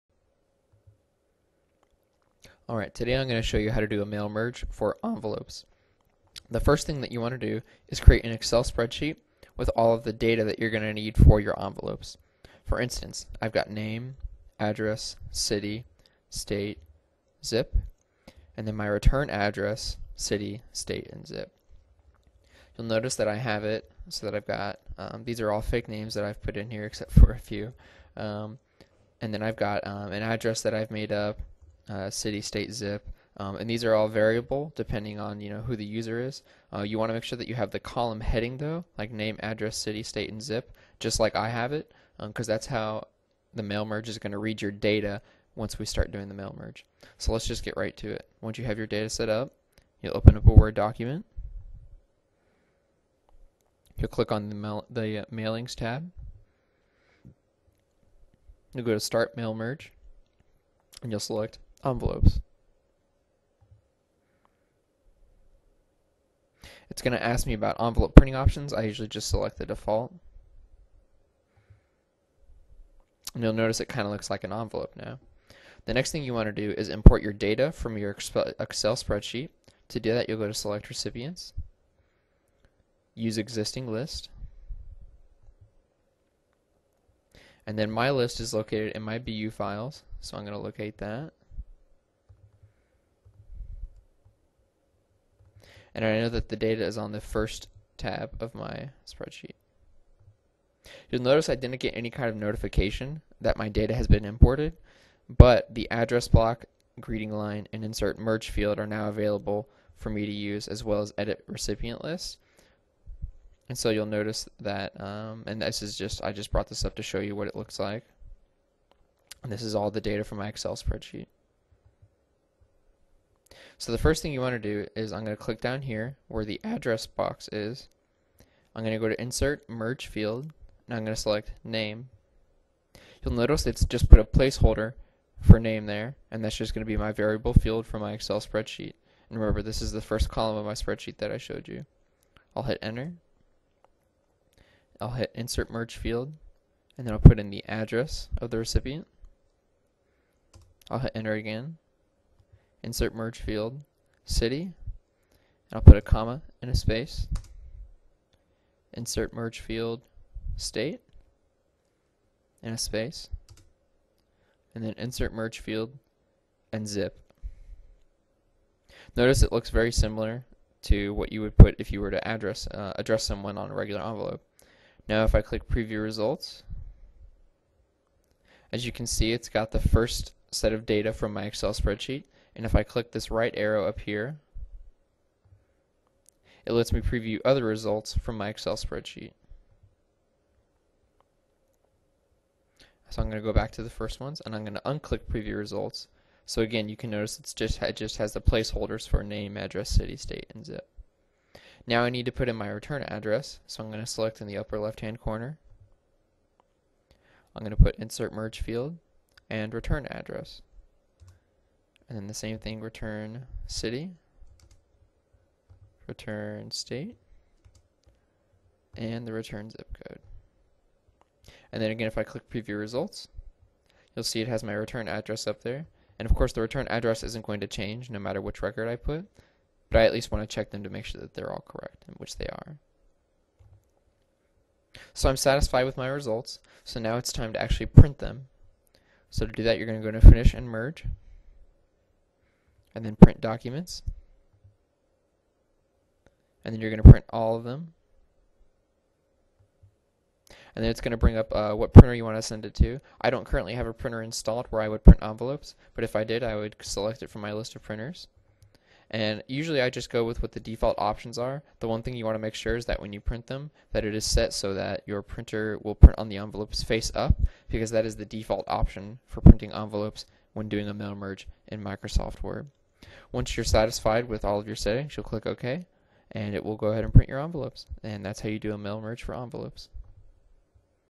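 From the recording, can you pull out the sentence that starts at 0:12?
For instance, I've got name, address, city, state, zip, and then my return address, city, state, and zip.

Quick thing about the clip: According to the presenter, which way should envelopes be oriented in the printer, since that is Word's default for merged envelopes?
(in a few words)
Face up.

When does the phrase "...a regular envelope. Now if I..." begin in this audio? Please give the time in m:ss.
2:53.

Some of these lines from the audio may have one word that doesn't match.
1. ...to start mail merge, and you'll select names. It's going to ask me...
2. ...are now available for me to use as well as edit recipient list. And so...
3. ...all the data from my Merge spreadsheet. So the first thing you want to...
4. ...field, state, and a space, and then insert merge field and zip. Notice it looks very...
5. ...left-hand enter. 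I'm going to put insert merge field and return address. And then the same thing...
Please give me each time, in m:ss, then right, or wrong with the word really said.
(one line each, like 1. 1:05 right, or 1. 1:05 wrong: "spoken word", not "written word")
1. 0:58 wrong: "envelopes", not "names"
2. 1:48 right
3. 1:59 wrong: "Excel", not "Merge"
4. 2:39 right
5. 3:24 wrong: "corner", not "enter".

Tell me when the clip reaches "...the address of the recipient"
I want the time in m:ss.
2:27.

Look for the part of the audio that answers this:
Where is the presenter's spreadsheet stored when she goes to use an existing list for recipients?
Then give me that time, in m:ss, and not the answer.
1:29.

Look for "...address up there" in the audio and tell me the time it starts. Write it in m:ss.
3:45.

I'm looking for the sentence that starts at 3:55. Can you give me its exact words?
So I'm satisfied with my results, so now it's time to actually print them.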